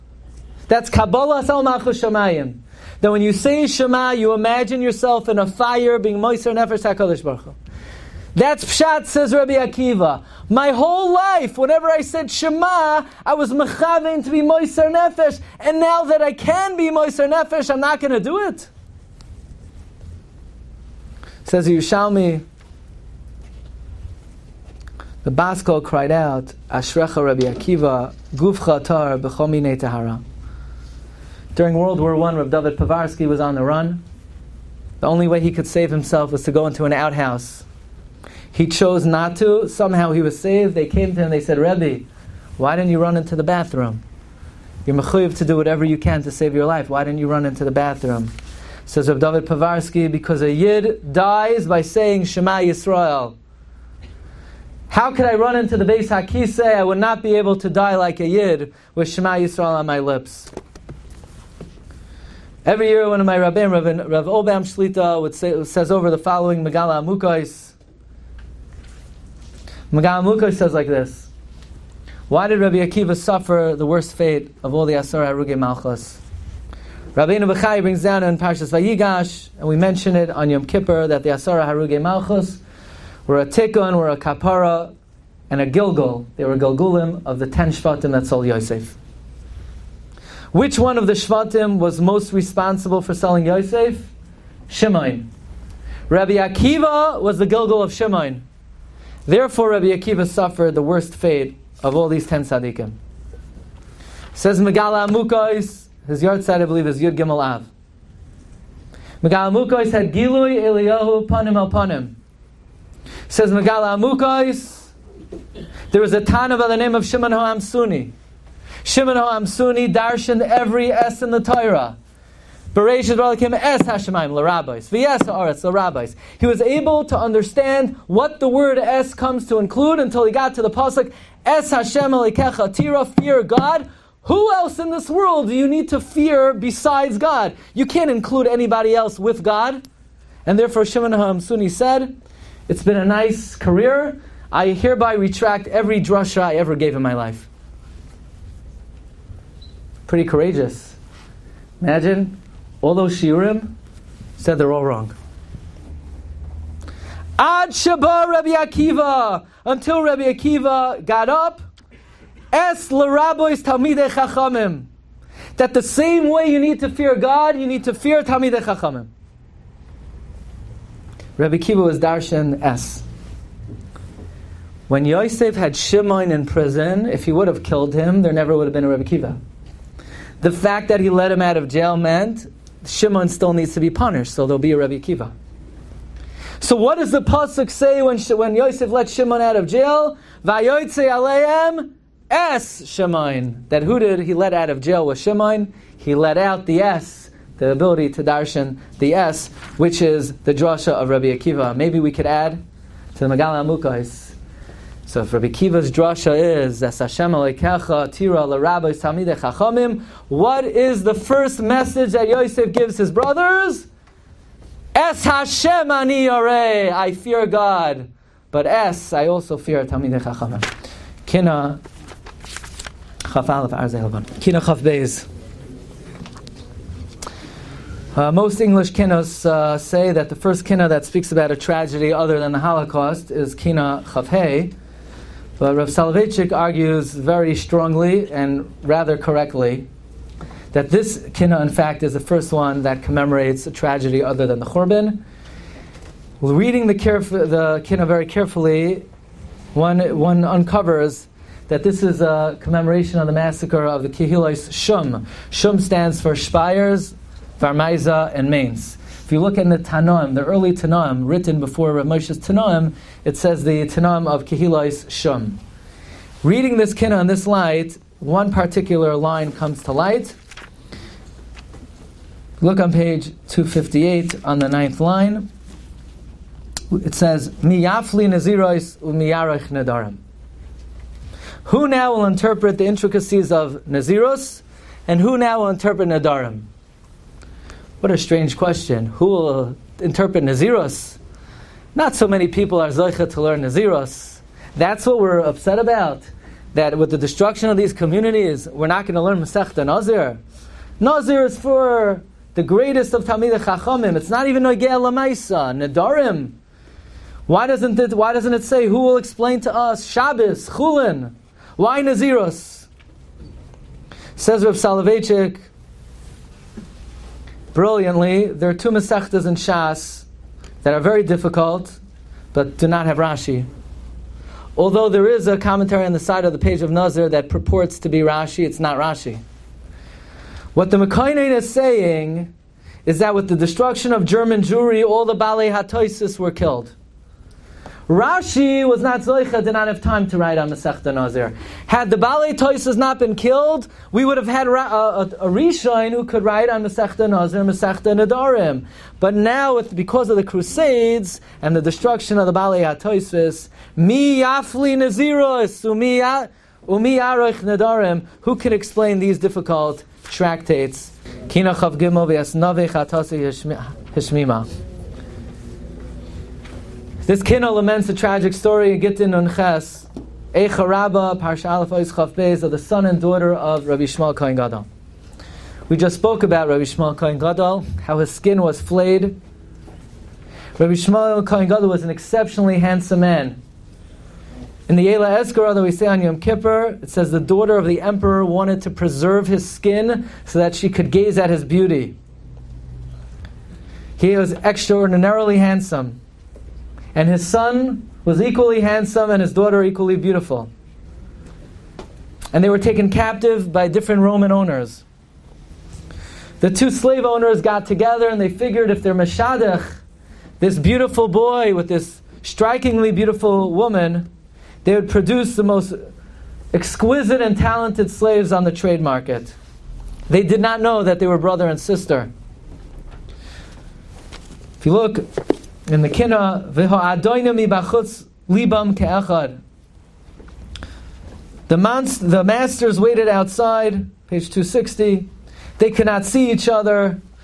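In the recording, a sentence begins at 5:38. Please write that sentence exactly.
Rashi was not Zoicha, did not have time to write on Masechta Nazir.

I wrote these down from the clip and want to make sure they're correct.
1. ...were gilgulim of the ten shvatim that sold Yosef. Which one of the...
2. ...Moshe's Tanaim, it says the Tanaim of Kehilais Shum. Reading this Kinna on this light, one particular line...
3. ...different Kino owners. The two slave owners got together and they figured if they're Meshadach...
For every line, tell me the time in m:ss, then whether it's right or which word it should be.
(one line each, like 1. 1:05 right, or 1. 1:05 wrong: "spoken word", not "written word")
1. 1:26 right
2. 4:22 right
3. 6:43 wrong: "Roman", not "Kino".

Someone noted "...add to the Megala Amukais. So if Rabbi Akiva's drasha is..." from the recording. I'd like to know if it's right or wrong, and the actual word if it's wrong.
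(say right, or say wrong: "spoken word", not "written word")
right.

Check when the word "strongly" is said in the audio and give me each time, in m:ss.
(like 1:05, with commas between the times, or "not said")
3:57.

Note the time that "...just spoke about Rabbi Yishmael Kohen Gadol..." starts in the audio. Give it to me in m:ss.
6:15.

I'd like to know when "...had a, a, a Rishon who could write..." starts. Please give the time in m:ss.
5:44.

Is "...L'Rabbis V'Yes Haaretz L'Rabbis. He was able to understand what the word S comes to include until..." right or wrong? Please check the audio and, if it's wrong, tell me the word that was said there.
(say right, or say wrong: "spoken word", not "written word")
right.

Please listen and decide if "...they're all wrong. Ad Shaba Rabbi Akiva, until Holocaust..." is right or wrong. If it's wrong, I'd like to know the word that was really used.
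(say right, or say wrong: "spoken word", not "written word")
wrong: "Rabbi", not "Holocaust".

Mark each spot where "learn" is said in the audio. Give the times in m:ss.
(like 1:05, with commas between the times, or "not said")
4:53, 4:59.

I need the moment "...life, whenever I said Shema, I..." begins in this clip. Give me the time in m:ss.
0:11.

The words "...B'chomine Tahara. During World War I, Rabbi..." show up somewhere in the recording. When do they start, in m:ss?
0:29.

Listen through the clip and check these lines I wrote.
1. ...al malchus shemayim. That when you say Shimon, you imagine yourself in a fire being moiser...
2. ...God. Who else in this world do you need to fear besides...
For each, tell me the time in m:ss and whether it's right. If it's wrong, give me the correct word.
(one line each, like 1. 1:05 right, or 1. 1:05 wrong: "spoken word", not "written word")
1. 0:01 wrong: "Shema", not "Shimon"
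2. 2:13 right.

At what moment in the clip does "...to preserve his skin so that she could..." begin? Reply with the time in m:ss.
6:28.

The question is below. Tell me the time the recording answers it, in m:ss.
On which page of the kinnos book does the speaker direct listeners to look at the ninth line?
4:33.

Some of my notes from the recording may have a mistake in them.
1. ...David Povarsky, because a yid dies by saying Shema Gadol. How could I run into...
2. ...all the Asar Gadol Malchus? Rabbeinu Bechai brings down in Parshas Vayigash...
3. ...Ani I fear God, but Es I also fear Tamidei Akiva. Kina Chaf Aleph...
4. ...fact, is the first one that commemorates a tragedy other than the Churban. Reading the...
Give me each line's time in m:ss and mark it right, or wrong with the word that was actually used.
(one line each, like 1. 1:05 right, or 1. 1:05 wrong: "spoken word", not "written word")
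1. 0:49 wrong: "Yisrael", not "Gadol"
2. 1:14 wrong: "Aruge", not "Gadol"
3. 3:35 wrong: "Chachamim", not "Akiva"
4. 4:01 right.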